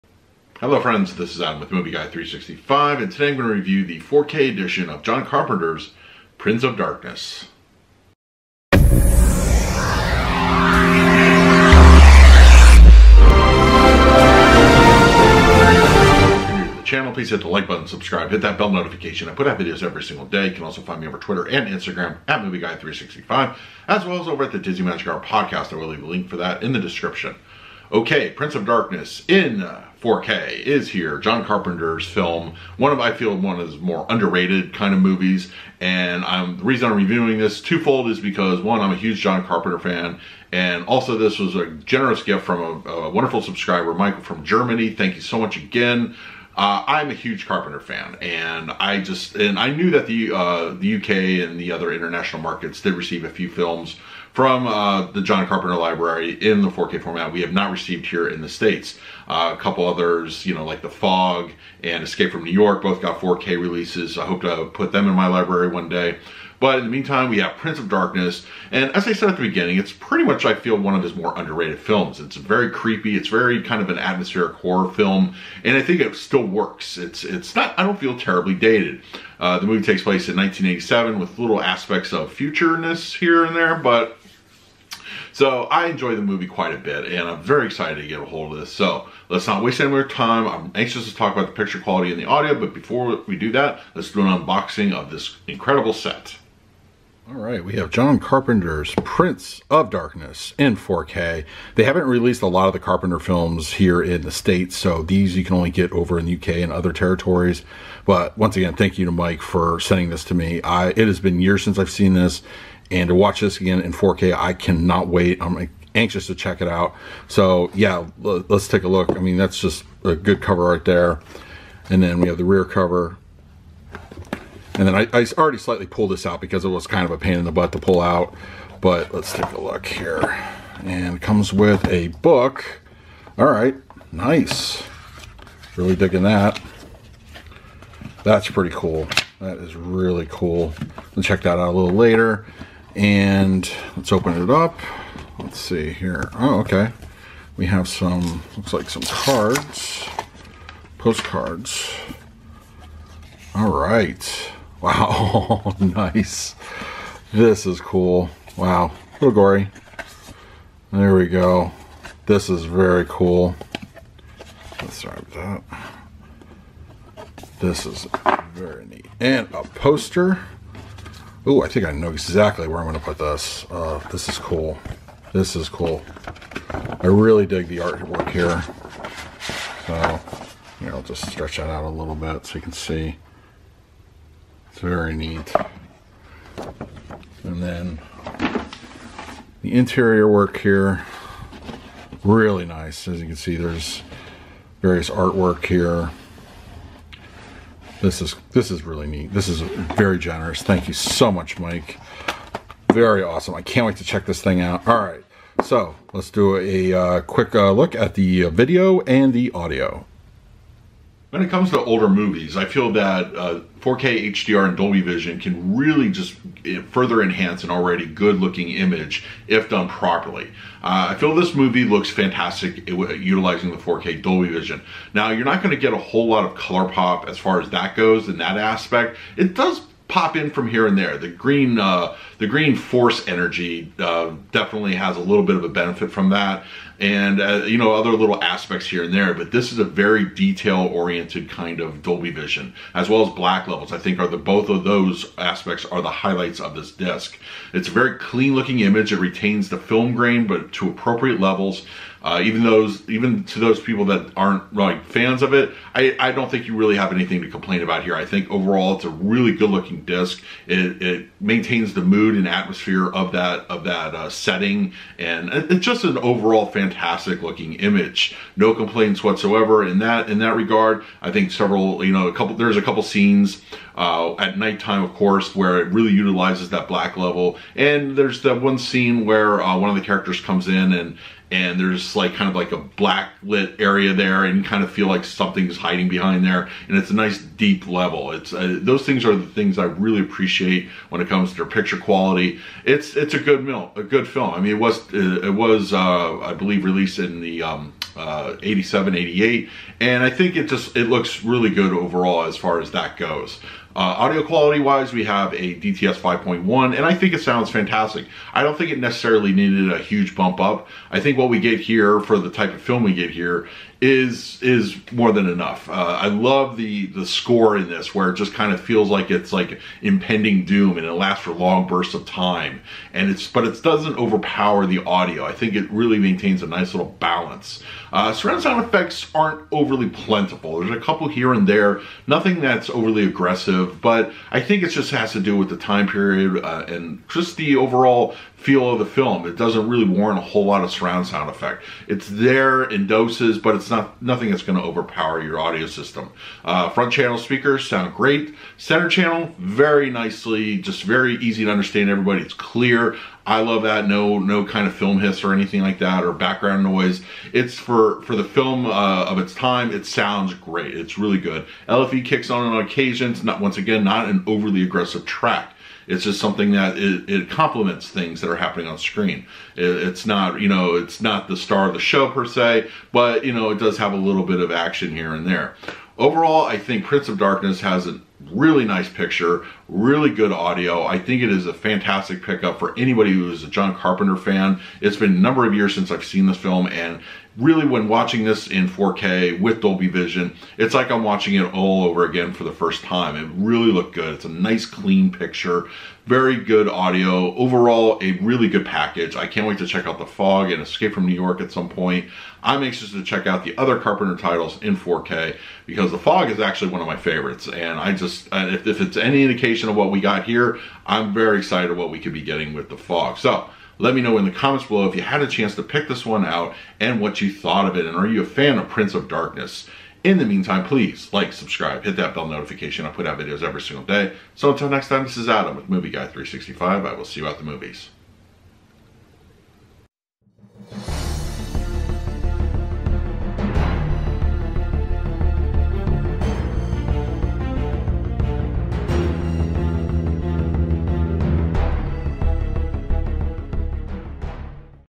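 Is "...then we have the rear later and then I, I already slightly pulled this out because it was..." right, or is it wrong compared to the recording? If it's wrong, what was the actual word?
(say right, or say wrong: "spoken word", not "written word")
wrong: "cover", not "later".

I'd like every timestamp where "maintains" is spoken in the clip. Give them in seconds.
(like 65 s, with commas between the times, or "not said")
261 s, 326 s.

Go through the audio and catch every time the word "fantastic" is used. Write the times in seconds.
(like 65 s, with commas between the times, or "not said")
222 s, 266 s, 307 s, 381 s.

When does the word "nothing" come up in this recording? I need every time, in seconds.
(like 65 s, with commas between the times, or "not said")
332 s, 344 s.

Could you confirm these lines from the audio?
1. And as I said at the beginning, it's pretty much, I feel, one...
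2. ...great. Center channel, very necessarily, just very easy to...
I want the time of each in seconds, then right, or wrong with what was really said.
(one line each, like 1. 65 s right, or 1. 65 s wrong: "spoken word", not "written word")
1. 68 s right
2. 348 s wrong: "nicely", not "necessarily".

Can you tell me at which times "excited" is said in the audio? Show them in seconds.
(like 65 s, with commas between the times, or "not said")
87 s, 411 s.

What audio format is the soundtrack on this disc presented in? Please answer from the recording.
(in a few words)
DTS 5.1.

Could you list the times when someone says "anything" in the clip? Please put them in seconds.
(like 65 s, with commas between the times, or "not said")
257 s, 355 s.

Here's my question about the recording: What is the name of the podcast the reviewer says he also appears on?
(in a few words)
Disney Magic Hour.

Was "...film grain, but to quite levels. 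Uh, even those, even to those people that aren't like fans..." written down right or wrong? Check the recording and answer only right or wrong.
wrong.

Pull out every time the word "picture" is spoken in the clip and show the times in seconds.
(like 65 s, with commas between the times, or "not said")
91 s, 291 s, 379 s, 395 s.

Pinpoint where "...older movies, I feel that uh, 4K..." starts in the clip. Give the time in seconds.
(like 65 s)
211 s.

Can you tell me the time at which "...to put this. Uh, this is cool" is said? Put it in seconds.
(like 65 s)
172 s.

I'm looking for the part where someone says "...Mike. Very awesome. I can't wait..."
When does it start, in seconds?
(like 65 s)
201 s.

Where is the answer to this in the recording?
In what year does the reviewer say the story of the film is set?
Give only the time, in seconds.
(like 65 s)
80 s.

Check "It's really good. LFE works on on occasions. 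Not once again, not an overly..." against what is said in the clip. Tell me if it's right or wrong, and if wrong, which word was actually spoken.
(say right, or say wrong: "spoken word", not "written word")
wrong: "kicks", not "works".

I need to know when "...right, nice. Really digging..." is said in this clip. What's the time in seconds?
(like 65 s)
133 s.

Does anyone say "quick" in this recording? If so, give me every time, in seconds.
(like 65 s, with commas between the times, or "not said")
207 s.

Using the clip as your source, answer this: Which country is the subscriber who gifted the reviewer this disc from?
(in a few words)
Germany.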